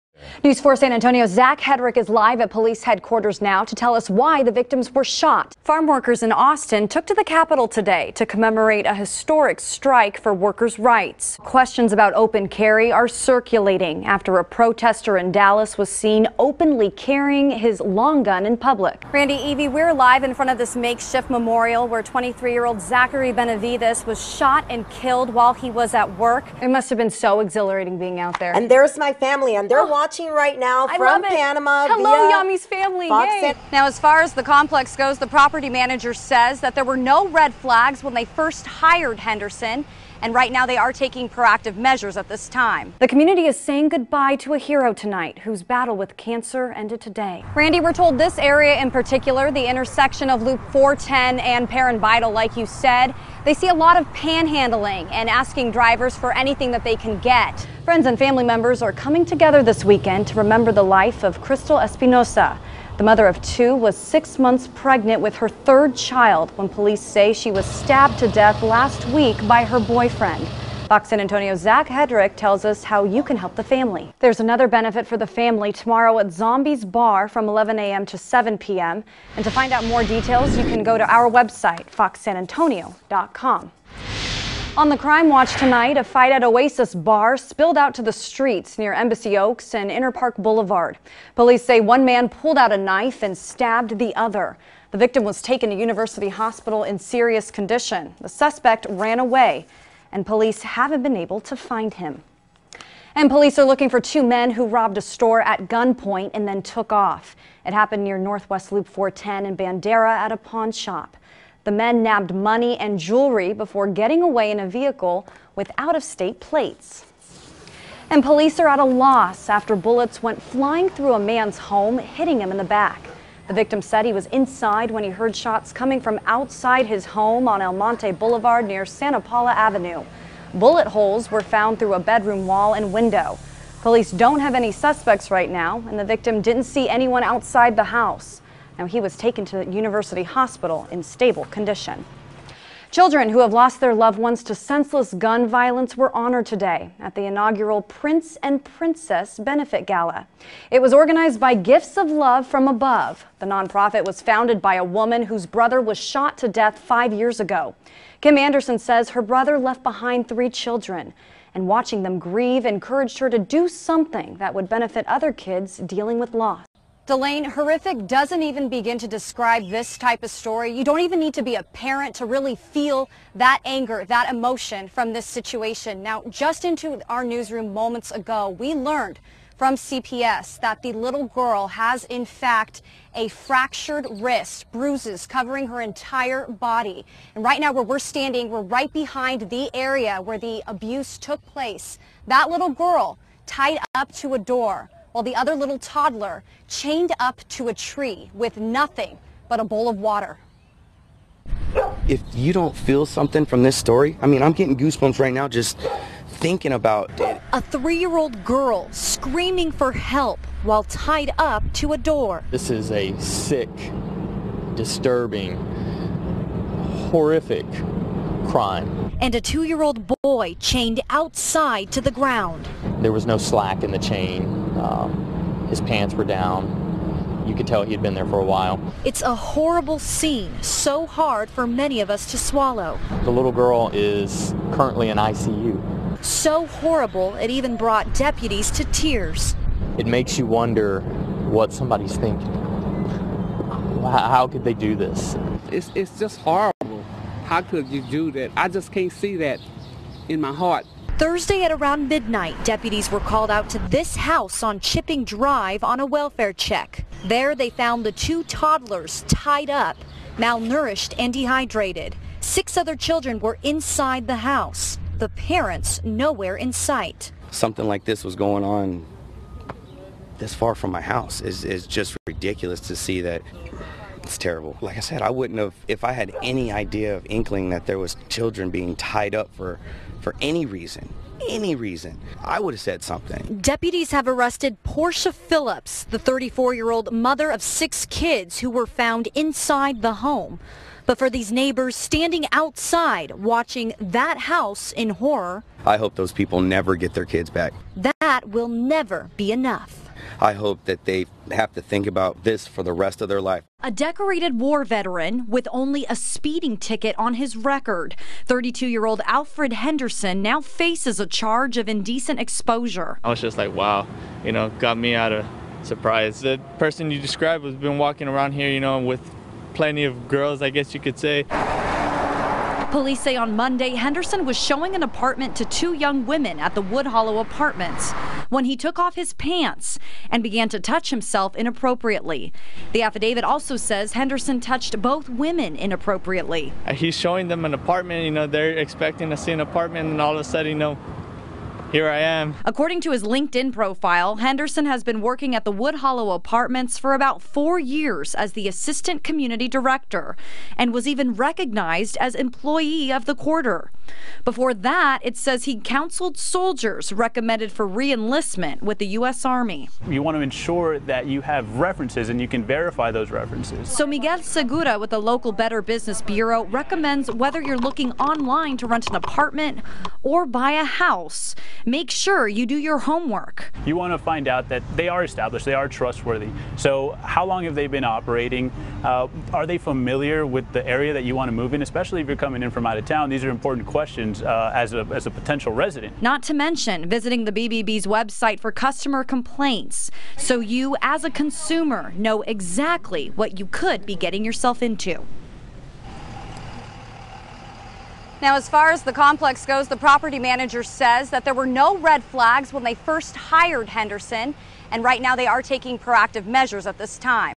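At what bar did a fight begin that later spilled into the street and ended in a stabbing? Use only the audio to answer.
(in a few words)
Oasis Bar.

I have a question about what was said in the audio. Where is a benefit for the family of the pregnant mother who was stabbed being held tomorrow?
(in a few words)
Zombies Bar.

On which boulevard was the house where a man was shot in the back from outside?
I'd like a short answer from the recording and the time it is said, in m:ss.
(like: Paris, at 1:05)
El Monte Boulevard, at 2:07.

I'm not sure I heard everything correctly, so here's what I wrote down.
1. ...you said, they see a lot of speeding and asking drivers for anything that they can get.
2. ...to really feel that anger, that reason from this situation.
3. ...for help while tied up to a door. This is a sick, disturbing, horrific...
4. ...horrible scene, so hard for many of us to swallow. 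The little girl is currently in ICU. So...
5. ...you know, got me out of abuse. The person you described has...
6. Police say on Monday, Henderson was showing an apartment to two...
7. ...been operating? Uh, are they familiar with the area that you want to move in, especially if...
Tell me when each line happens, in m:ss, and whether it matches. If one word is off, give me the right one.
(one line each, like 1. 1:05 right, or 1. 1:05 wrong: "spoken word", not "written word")
1. 0:52 wrong: "panhandling", not "speeding"
2. 2:52 wrong: "emotion", not "reason"
3. 3:29 right
4. 3:49 right
5. 5:14 wrong: "surprise", not "abuse"
6. 5:22 right
7. 6:17 right.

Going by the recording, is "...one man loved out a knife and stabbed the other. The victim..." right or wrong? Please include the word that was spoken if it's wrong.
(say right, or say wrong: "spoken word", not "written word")
wrong: "pulled", not "loved".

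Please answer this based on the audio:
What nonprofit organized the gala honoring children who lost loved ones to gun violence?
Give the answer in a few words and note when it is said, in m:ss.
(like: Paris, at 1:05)
Gifts of Love from Above, at 2:31.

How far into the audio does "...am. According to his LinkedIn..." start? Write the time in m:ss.
5:42.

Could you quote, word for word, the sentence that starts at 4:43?
Deputies have arrested Portia Phillips, the 34-year-old mother of six kids who were found inside the home.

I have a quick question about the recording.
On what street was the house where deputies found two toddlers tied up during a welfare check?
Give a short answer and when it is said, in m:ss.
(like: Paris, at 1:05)
Chipping Drive, at 4:14.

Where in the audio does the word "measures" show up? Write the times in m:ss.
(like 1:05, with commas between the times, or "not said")
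0:41, 6:46.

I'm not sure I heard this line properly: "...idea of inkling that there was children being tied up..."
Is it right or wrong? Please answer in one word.
right.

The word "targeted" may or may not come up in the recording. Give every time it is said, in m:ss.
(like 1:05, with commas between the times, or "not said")
not said.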